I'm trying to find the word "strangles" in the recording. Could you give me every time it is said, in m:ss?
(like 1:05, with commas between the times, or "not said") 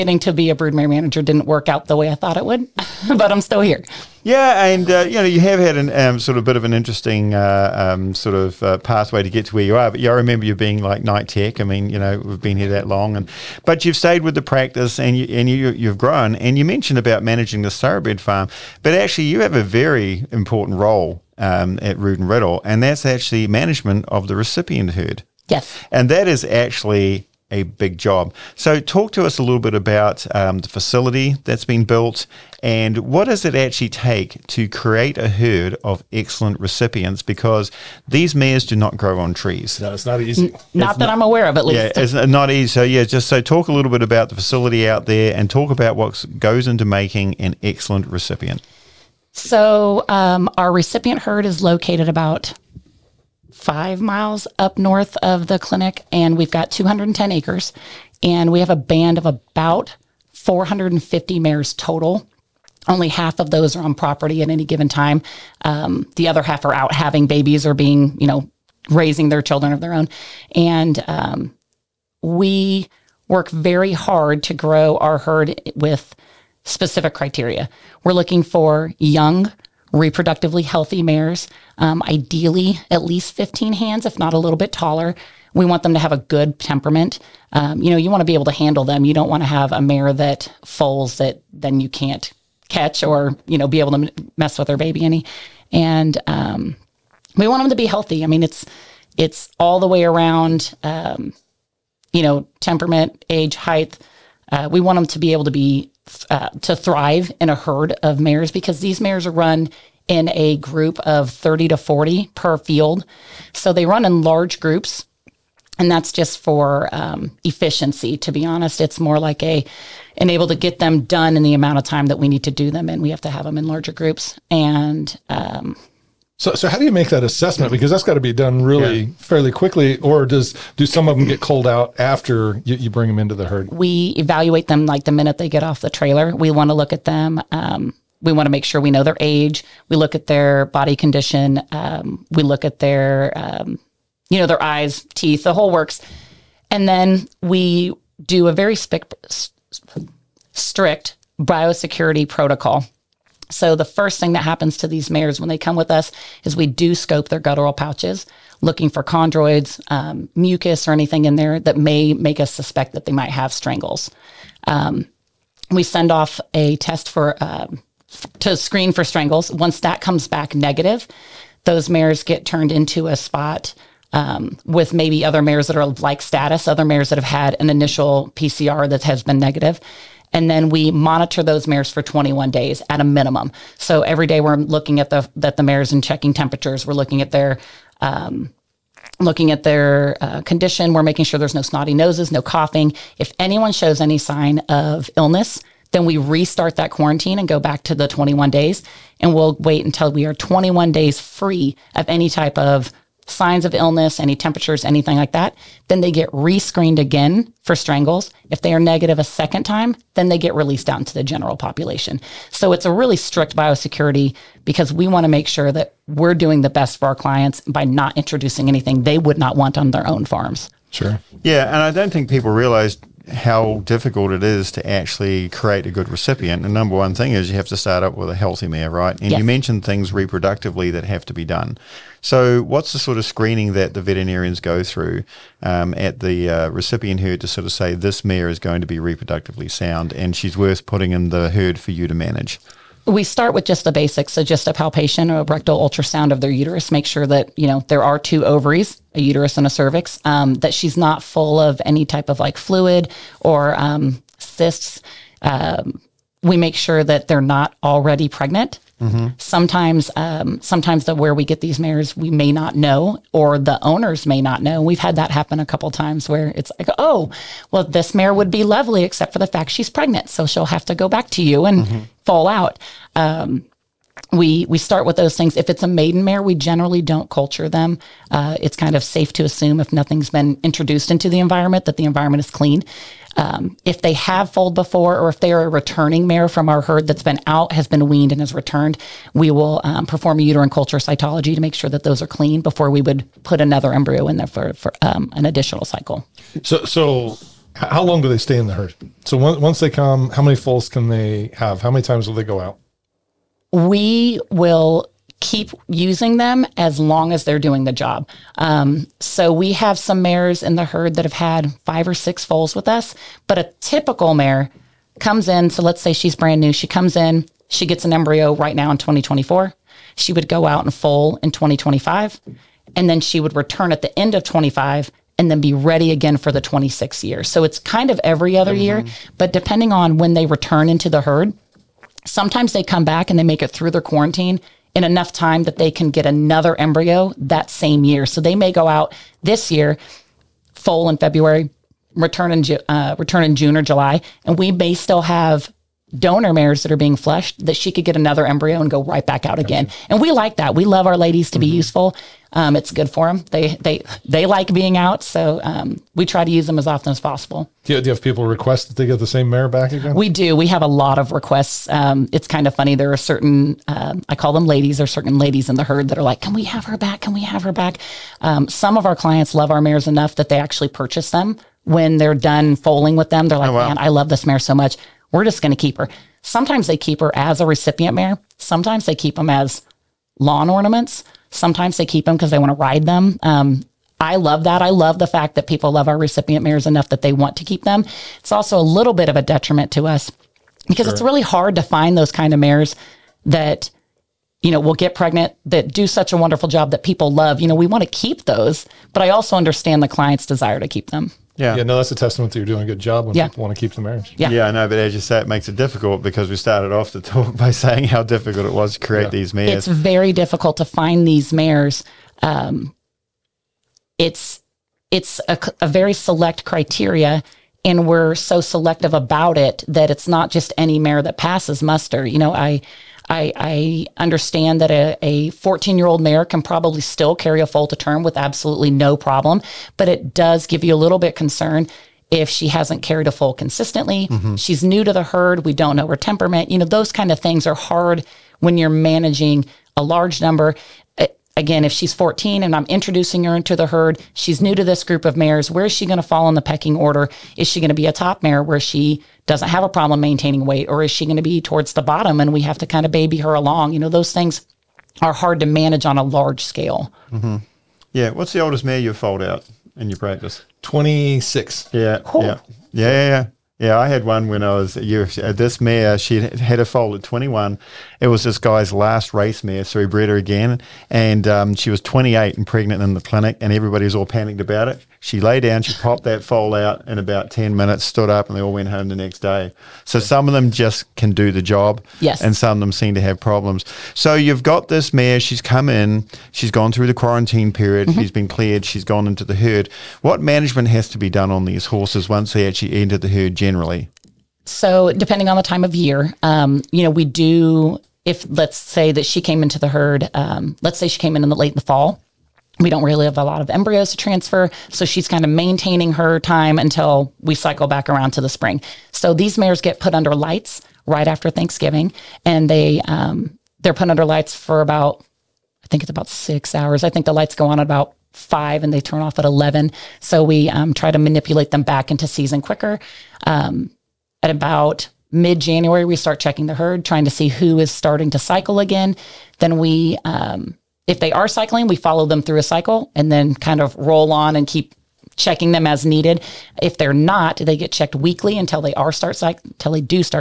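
2:43, 2:49, 3:27.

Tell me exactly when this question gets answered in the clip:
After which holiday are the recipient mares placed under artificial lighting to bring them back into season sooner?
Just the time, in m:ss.
8:31.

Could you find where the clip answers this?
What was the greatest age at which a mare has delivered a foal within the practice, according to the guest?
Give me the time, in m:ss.
7:40.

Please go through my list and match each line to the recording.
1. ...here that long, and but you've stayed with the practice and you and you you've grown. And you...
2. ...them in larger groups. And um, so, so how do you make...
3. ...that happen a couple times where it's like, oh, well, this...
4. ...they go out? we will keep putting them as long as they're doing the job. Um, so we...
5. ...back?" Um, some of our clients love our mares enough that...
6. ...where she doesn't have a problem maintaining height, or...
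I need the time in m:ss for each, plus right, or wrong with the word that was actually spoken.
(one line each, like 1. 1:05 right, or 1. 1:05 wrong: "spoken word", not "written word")
1. 0:12 right
2. 2:03 right
3. 4:25 right
4. 5:02 wrong: "using", not "putting"
5. 6:07 right
6. 7:28 wrong: "weight", not "height".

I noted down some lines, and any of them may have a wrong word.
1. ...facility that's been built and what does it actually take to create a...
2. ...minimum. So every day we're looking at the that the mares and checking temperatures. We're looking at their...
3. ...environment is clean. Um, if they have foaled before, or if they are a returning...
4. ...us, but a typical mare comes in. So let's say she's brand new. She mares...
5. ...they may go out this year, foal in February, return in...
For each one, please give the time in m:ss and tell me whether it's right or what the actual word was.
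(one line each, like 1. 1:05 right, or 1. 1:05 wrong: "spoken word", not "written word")
1. 0:30 right
2. 3:03 right
3. 4:42 right
4. 5:12 wrong: "comes", not "mares"
5. 5:38 right.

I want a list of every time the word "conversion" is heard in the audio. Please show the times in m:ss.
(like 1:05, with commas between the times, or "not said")
not said.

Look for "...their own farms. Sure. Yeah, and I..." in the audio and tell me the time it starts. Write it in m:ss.
3:39.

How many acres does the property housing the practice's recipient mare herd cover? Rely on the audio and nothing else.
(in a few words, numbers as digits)
210.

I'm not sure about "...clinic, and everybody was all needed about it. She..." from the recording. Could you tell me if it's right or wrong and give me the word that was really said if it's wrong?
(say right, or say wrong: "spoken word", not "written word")
wrong: "panicked", not "needed".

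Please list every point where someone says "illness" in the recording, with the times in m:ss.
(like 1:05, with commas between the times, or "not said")
3:15, 3:23.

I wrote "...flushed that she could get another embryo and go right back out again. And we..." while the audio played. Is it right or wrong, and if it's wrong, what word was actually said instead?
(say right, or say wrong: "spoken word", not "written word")
right.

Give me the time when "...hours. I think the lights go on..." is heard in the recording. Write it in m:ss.
8:36.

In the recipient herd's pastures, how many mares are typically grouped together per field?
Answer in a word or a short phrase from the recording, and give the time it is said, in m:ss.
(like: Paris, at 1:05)
30 to 40, at 1:51.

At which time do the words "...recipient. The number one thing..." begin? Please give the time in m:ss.
3:46.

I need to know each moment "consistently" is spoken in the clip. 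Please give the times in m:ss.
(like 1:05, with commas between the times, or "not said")
7:13.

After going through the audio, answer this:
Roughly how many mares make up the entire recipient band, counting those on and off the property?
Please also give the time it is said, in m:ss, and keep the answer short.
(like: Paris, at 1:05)
450, at 1:00.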